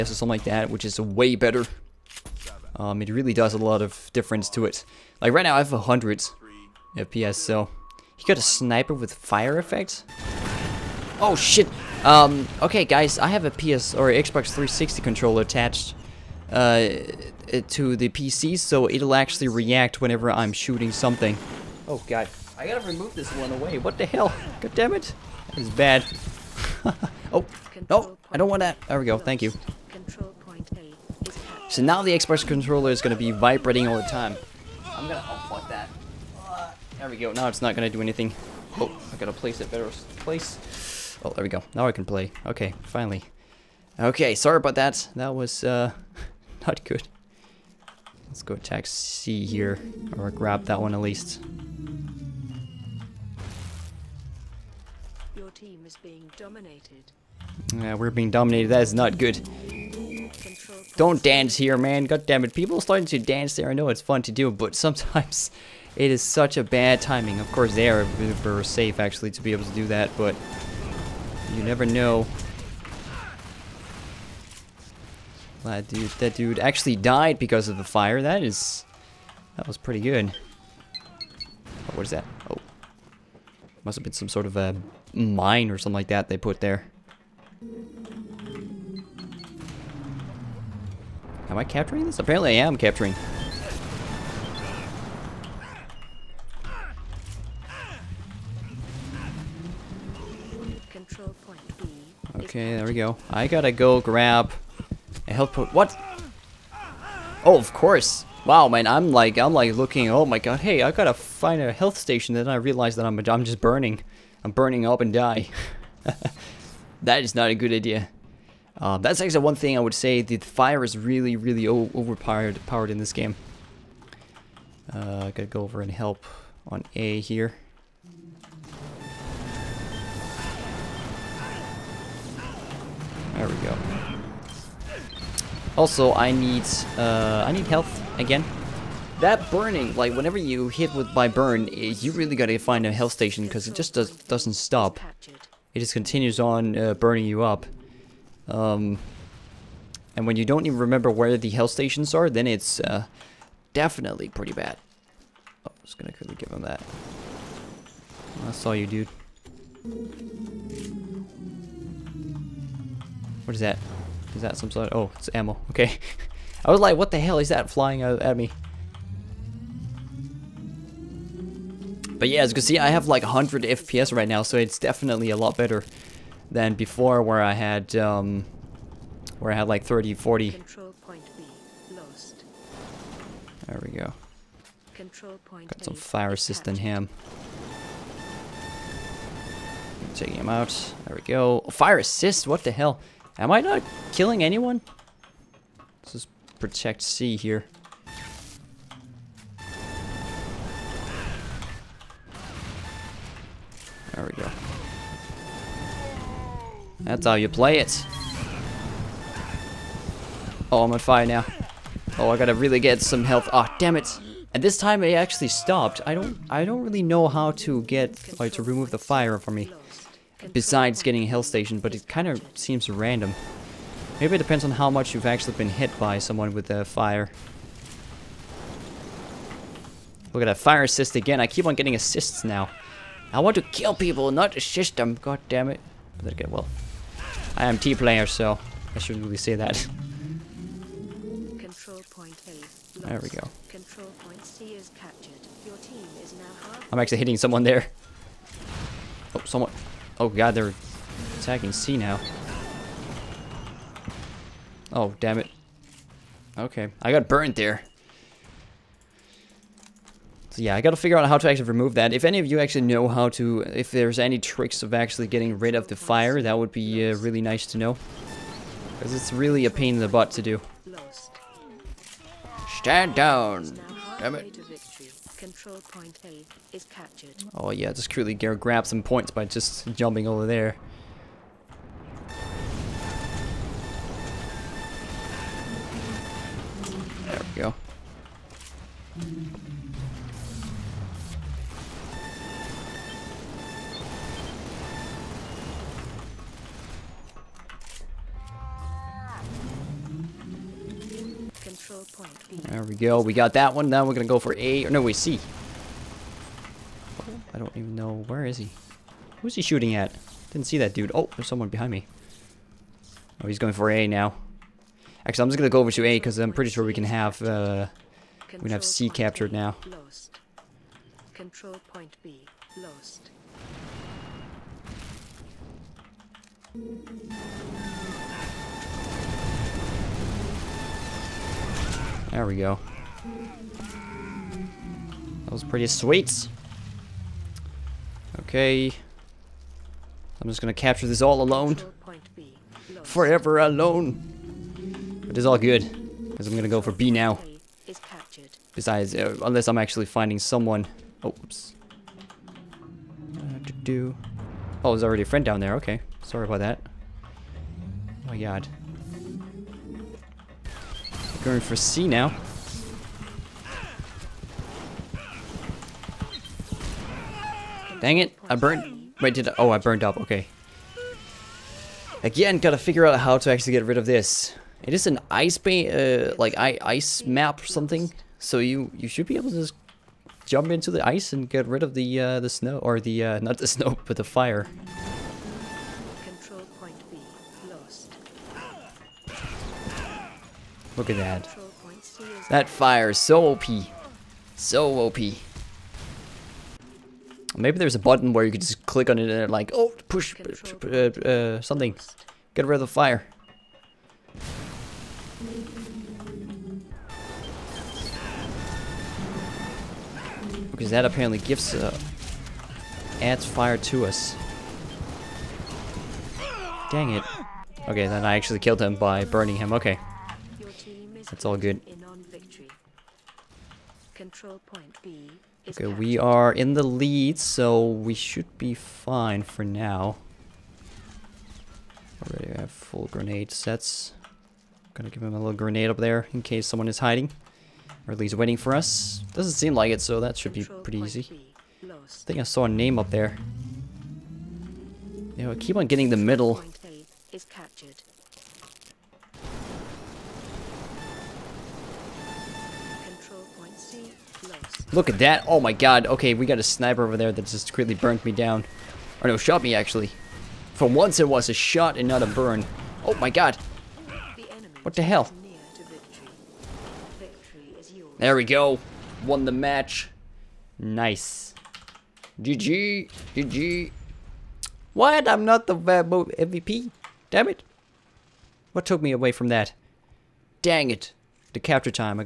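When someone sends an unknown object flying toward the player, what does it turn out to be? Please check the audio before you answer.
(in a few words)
ammo.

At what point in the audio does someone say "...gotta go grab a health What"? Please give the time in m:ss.
1:43.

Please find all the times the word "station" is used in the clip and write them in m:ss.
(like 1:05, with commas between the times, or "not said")
1:51, 2:23, 2:31, 3:41.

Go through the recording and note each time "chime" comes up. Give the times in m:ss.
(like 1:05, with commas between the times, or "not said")
not said.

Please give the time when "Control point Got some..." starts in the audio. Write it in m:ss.
3:04.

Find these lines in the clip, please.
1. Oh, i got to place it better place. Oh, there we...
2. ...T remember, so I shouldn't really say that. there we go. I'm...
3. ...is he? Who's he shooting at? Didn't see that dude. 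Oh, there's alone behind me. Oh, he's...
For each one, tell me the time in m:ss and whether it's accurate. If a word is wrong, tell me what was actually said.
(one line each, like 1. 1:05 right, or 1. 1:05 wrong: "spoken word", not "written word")
1. 0:38 right
2. 3:57 wrong: "player", not "remember"
3. 5:08 wrong: "someone", not "alone".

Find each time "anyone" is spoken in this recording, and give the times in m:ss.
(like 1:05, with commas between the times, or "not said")
3:14.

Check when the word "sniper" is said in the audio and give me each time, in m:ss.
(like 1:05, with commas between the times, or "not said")
0:08, 7:36.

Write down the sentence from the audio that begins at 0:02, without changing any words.
Um, it really does a lot of difference to it.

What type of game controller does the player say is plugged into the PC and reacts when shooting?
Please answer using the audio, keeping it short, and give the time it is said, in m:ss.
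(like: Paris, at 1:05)
Xbox 360 controller, at 0:14.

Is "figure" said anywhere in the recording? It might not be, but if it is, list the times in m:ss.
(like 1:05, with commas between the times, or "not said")
4:20, 6:12.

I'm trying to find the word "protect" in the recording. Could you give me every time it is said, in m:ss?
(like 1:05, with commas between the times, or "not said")
3:16.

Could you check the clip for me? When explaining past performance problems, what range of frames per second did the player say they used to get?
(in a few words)
30, 40.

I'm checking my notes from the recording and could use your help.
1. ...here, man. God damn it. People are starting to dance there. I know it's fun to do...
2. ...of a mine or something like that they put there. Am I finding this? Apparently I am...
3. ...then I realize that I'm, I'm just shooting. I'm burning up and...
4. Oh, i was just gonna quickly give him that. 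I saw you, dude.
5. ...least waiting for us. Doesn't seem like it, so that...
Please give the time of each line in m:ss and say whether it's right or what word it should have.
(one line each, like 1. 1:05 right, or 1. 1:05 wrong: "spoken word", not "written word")
1. 1:01 right
2. 1:24 wrong: "capturing", not "finding"
3. 1:52 wrong: "burning", not "shooting"
4. 2:35 right
5. 7:18 right.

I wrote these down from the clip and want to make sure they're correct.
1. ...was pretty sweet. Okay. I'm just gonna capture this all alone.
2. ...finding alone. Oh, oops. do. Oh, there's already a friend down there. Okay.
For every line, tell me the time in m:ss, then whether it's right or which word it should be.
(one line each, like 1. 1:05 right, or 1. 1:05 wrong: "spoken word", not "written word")
1. 5:35 right
2. 5:50 wrong: "someone", not "alone".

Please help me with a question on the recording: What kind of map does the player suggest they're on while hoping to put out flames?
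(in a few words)
ice map.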